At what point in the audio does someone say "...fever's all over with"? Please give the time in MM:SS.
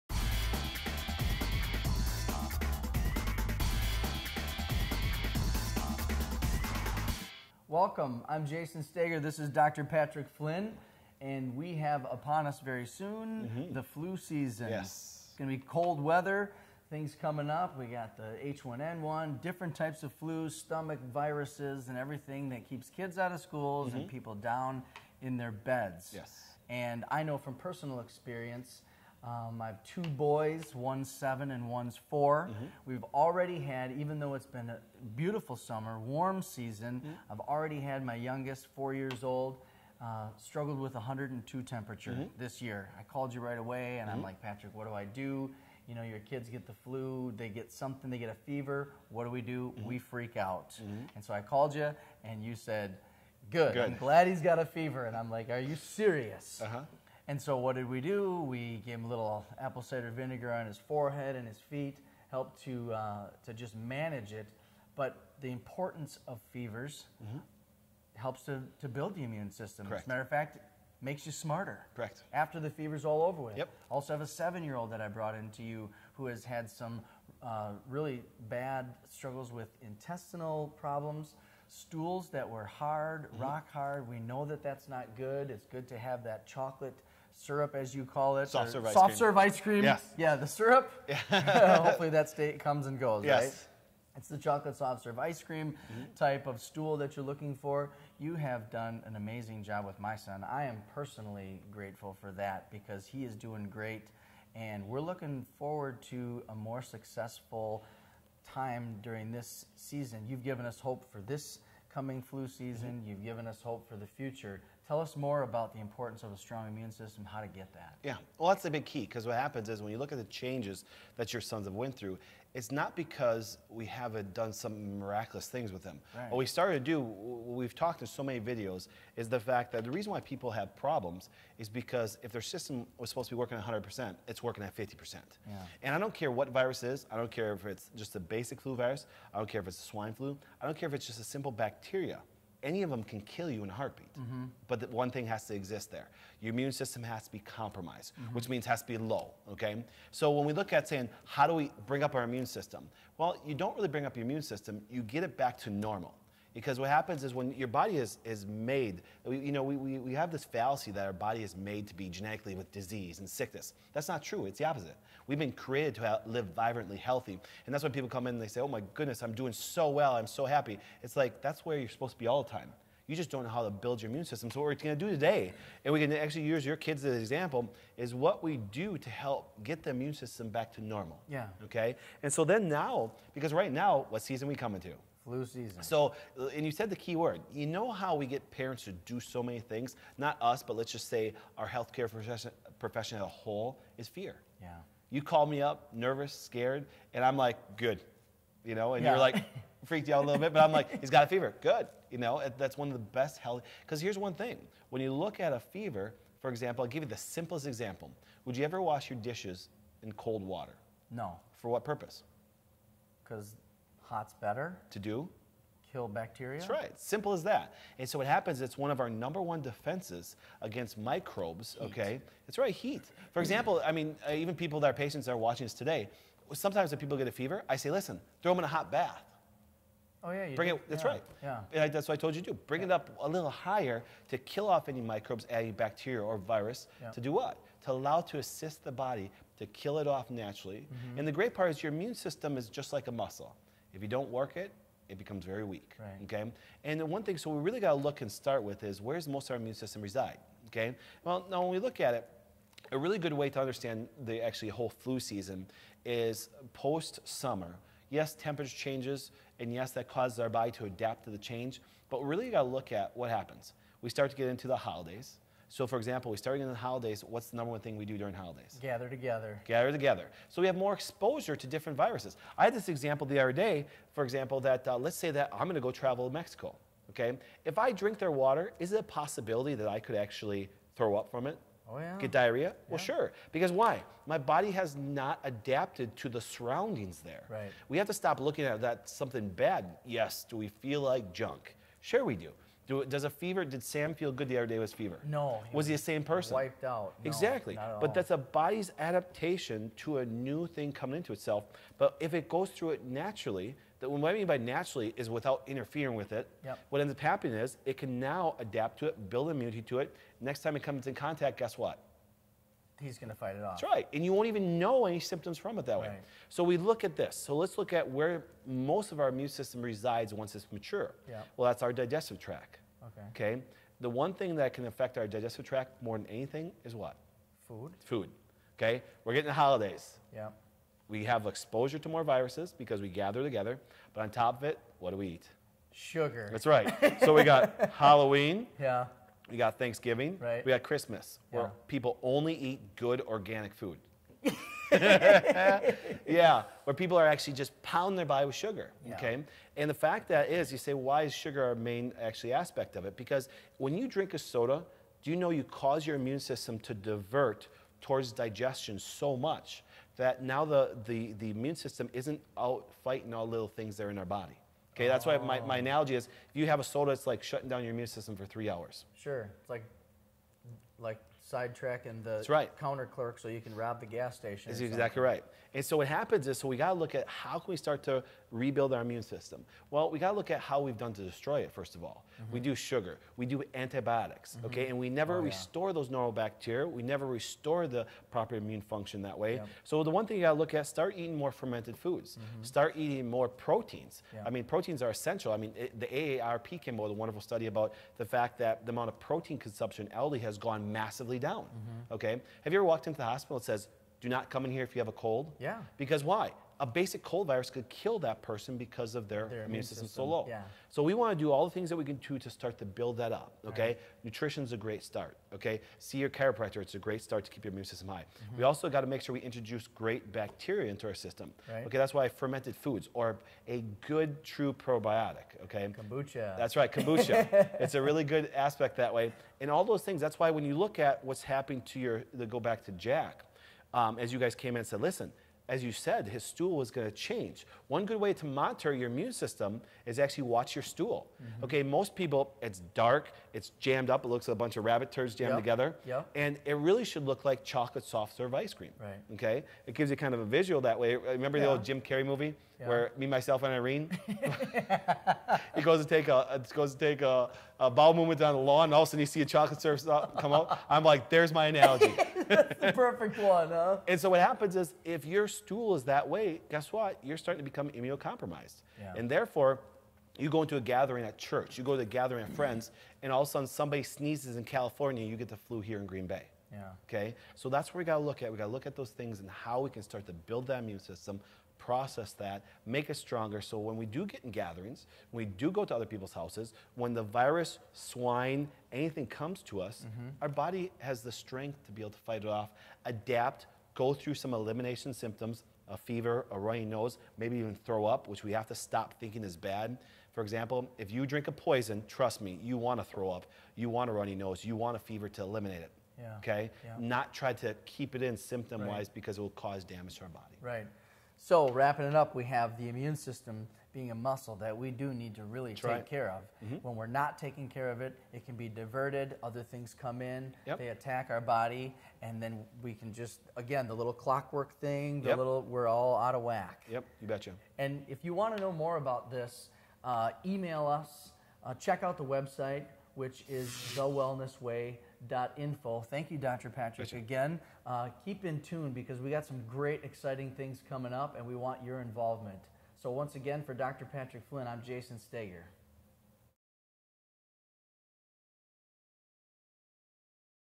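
01:12.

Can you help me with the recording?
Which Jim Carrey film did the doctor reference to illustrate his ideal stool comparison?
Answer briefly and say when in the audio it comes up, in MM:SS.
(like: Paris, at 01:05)
Me, Myself and Irene, at 07:33.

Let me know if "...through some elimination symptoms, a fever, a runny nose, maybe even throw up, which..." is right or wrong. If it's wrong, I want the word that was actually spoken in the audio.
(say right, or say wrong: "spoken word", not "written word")
right.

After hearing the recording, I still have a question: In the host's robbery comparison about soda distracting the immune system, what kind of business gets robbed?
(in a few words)
gas station.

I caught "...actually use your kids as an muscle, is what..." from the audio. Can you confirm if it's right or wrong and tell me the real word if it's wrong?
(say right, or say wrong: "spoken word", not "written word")
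wrong: "example", not "muscle".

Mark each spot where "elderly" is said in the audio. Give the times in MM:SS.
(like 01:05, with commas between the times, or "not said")
06:40.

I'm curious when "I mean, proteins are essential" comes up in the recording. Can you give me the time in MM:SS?
06:34.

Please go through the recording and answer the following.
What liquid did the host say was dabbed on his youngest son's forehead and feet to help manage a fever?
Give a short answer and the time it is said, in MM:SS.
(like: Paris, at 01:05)
apple cider vinegar, at 00:59.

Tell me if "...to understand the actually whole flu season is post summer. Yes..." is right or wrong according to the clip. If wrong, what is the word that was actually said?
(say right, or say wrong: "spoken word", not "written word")
right.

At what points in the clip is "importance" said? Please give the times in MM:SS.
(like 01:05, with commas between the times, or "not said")
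01:05, 01:55.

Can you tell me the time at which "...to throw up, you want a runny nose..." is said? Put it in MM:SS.
08:22.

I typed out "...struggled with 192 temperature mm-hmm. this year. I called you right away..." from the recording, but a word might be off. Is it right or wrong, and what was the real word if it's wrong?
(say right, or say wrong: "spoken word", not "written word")
wrong: "102", not "192".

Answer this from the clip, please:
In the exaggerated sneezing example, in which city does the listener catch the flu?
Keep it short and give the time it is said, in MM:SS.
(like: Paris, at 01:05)
Green Bay, at 07:56.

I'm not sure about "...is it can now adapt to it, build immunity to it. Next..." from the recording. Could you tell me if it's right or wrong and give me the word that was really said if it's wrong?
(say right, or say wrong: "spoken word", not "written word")
right.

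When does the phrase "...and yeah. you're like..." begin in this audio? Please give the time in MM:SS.
03:18.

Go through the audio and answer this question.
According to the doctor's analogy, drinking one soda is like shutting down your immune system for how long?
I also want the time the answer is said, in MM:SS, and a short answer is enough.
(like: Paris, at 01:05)
3 hours, at 06:08.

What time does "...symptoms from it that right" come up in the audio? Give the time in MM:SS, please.
05:15.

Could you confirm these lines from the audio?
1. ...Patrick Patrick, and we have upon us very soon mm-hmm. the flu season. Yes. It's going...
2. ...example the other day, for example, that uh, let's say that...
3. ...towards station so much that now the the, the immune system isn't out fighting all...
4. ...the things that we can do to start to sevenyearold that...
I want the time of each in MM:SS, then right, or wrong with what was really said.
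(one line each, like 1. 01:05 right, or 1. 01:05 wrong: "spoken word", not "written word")
1. 00:09 wrong: "Flynn", not "Patrick"
2. 04:32 right
3. 05:58 wrong: "digestion", not "station"
4. 06:51 wrong: "build", not "sevenyearold".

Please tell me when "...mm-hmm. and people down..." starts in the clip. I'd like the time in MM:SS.
00:23.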